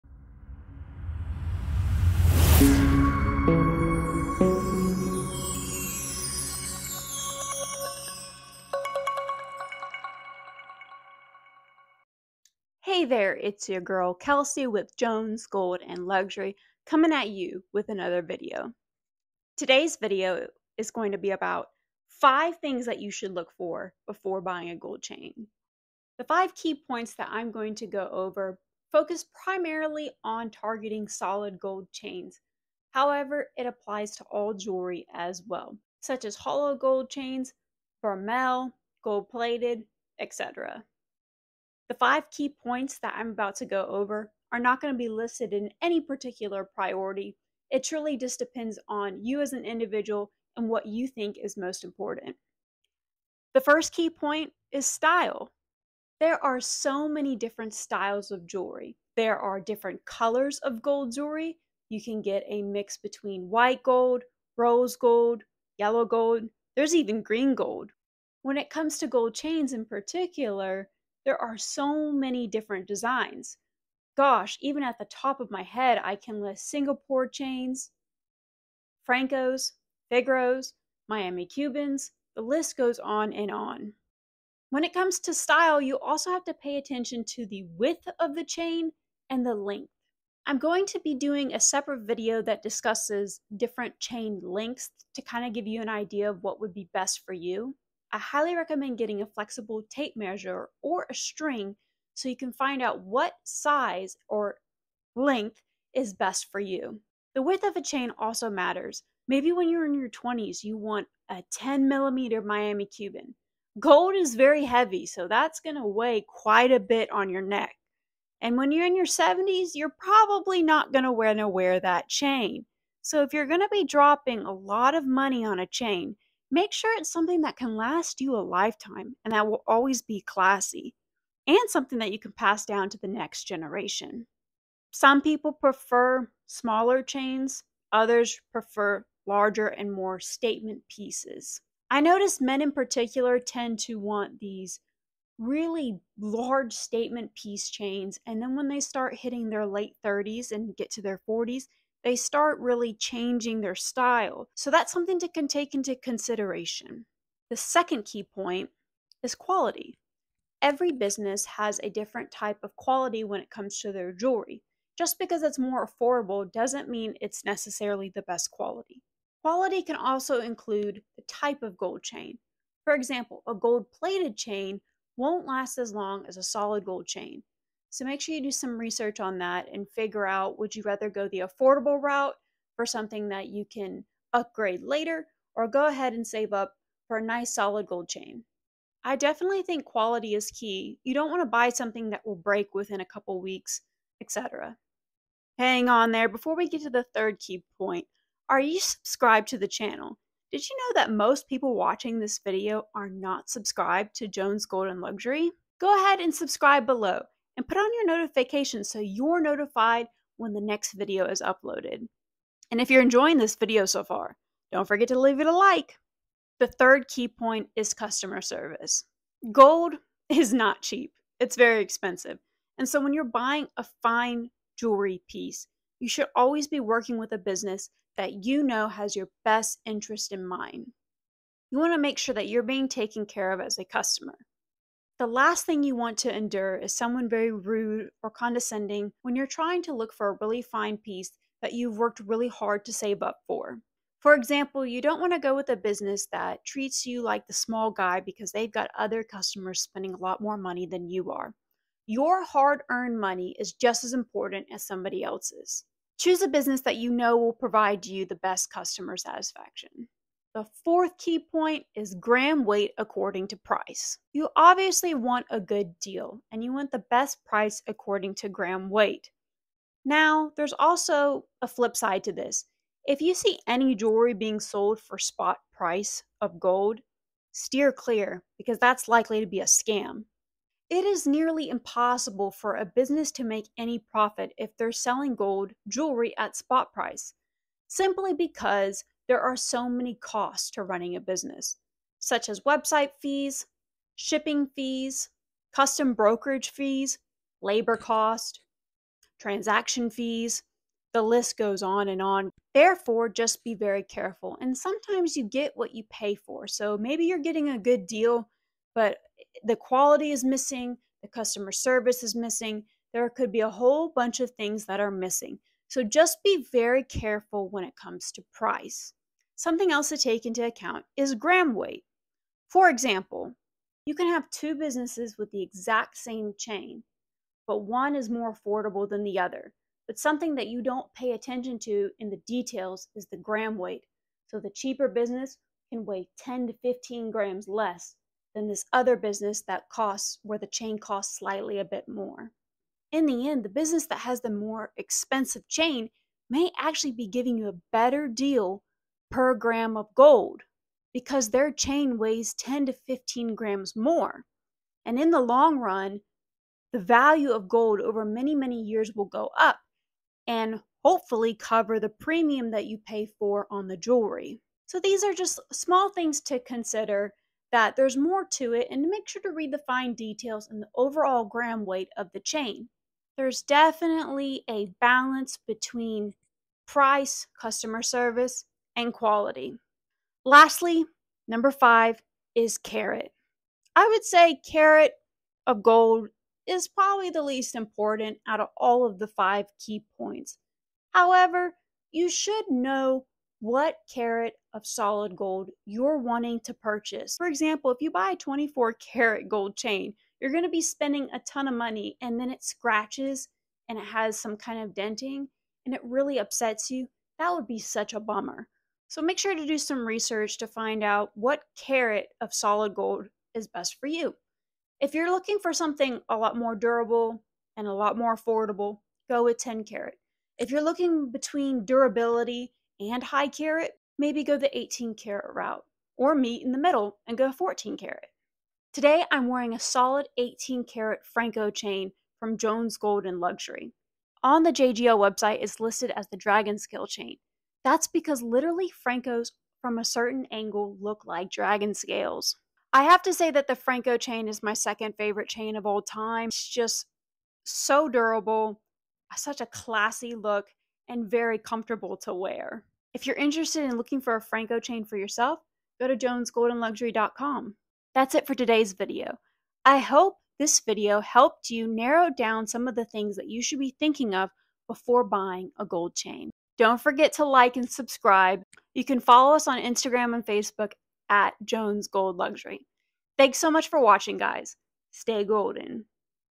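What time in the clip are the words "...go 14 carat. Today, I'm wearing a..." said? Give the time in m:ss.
7:07.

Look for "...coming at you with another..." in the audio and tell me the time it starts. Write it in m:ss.
0:16.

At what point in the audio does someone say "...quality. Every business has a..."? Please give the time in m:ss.
2:39.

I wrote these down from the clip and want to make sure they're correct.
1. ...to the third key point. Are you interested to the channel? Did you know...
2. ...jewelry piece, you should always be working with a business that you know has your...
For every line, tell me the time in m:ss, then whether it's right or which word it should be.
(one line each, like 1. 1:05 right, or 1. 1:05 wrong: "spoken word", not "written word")
1. 3:16 wrong: "subscribed", not "interested"
2. 3:44 right.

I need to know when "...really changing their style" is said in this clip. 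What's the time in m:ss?
2:32.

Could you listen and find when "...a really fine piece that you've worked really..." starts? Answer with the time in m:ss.
4:00.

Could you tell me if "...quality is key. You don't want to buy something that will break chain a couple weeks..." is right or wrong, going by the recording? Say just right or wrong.
wrong.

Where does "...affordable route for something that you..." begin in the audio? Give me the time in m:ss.
3:01.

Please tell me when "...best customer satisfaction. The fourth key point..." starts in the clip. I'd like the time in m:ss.
4:18.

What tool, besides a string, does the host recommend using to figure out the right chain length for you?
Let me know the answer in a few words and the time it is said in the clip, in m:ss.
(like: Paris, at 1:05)
Flexible tape measure, at 1:39.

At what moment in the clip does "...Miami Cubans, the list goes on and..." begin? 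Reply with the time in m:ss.
1:21.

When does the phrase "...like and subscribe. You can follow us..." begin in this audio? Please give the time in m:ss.
7:47.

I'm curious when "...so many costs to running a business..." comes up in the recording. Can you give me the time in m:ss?
4:49.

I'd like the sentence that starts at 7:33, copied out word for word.
If you're interested in looking for a Franco chain for yourself, go to jonesgoldenluxury.com.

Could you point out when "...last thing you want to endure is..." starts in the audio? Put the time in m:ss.
3:55.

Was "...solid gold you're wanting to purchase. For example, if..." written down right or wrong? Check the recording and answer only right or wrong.
right.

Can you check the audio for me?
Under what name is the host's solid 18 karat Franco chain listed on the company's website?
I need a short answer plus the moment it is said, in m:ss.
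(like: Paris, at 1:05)
Dragon Scale chain, at 7:16.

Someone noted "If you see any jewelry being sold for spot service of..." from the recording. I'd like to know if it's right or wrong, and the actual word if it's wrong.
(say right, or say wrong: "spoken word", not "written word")
wrong: "price", not "service".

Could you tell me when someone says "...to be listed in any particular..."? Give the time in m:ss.
0:44.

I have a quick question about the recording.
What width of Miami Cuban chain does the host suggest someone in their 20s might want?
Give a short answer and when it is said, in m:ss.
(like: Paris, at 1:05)
10 millimeters, at 1:51.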